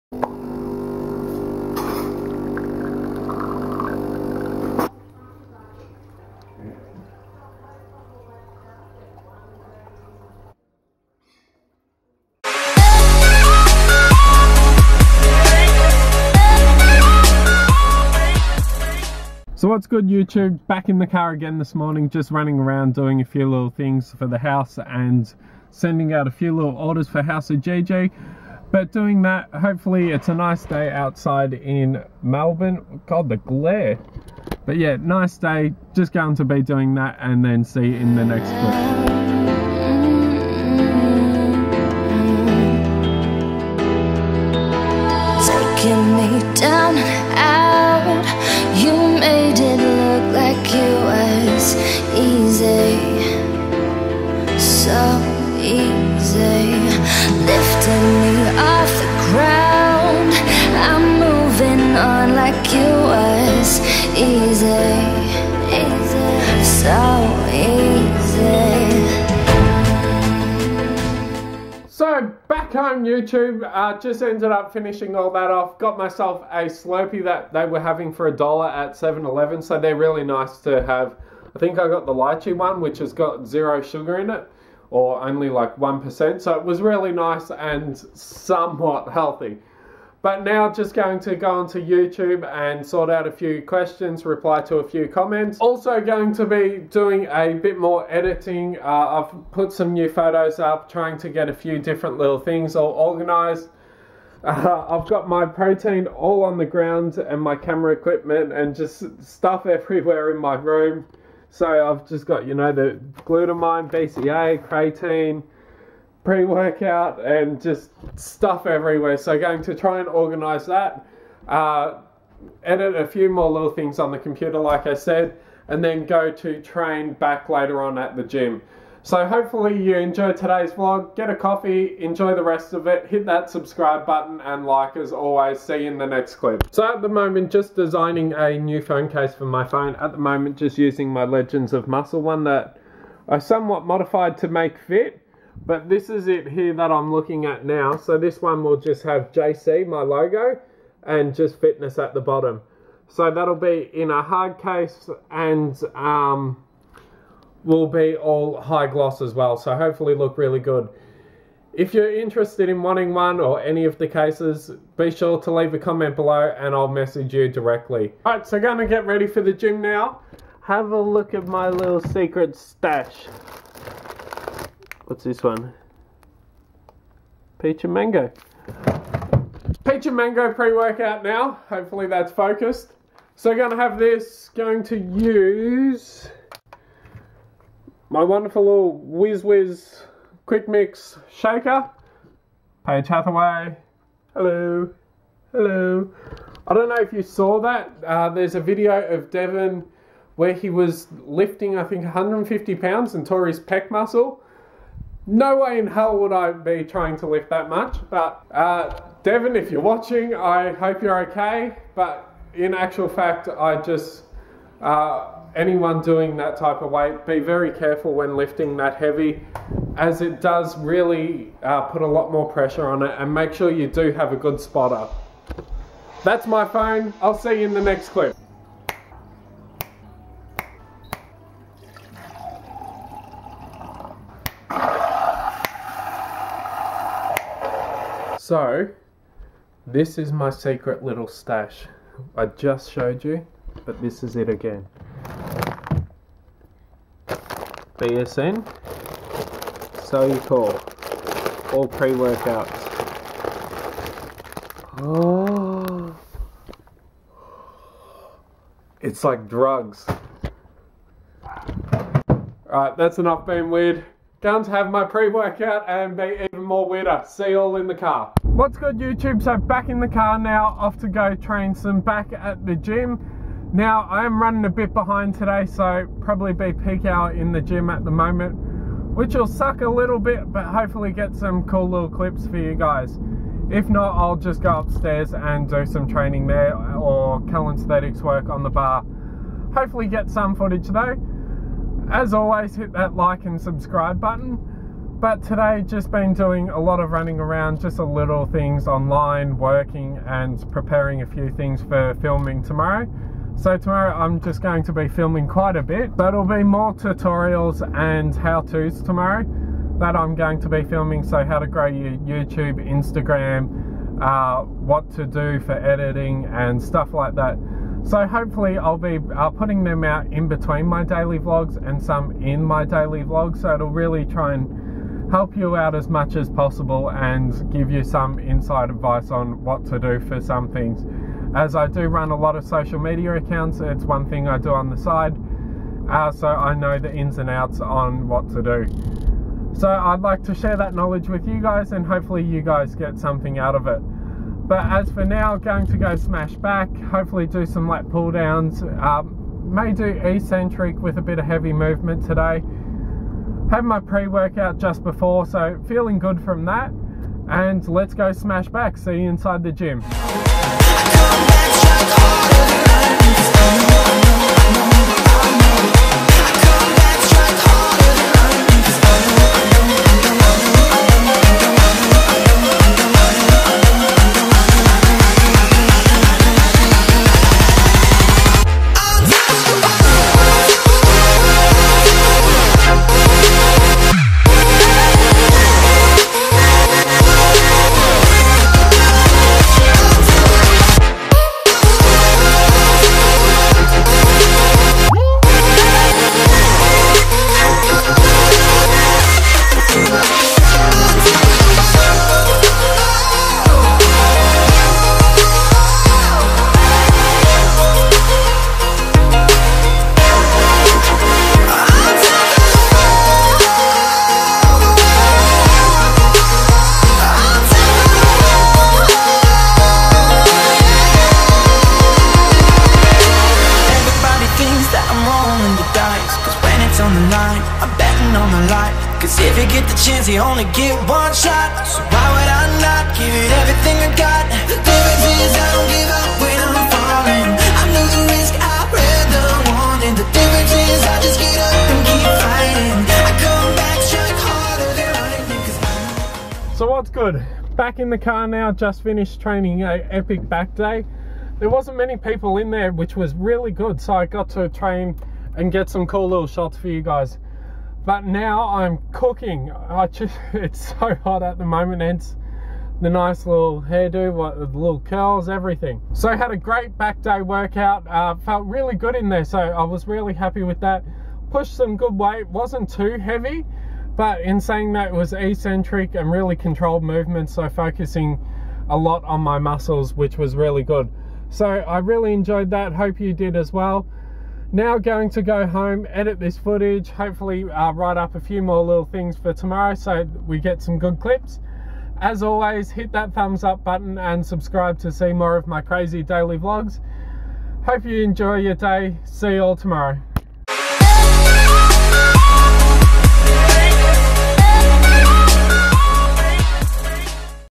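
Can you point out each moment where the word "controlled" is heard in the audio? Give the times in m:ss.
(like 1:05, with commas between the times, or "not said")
7:56.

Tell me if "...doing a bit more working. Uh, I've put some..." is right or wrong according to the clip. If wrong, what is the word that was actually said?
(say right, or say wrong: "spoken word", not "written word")
wrong: "editing", not "working".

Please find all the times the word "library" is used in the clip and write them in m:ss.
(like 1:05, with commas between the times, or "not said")
not said.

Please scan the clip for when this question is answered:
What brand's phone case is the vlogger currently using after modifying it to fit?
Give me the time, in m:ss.
2:21.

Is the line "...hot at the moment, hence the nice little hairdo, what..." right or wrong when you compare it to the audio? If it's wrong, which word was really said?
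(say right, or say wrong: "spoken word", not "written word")
right.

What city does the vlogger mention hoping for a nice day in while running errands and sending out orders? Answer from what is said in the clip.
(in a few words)
Melbourne.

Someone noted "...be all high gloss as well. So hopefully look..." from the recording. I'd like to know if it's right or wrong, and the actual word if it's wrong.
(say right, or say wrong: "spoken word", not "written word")
right.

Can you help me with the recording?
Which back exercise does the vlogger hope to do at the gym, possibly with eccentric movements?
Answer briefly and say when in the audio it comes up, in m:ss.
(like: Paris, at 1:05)
Lat pull downs, at 5:47.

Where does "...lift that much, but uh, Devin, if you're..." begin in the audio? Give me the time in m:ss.
3:27.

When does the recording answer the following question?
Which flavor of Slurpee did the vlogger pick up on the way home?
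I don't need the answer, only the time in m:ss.
1:22.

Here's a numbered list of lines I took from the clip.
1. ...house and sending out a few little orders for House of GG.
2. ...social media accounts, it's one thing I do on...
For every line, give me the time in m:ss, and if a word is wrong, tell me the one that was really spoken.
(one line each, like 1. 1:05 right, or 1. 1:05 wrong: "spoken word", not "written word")
1. 0:24 right
2. 5:32 right.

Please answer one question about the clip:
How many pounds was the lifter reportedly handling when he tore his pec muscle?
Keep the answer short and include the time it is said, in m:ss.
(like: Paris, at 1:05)
150, at 3:22.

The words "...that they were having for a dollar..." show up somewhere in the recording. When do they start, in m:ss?
1:17.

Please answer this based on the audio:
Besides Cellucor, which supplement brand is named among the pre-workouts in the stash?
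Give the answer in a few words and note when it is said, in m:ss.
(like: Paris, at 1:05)
BSN, at 4:07.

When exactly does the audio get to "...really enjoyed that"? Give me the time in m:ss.
8:01.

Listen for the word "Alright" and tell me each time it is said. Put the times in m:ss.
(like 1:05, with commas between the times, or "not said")
2:48, 4:22.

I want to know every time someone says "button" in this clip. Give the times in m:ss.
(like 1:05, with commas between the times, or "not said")
2:14, 4:54, 8:13.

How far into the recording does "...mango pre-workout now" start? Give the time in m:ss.
3:00.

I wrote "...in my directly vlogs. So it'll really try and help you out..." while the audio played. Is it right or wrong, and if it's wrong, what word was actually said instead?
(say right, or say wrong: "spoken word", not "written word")
wrong: "daily", not "directly".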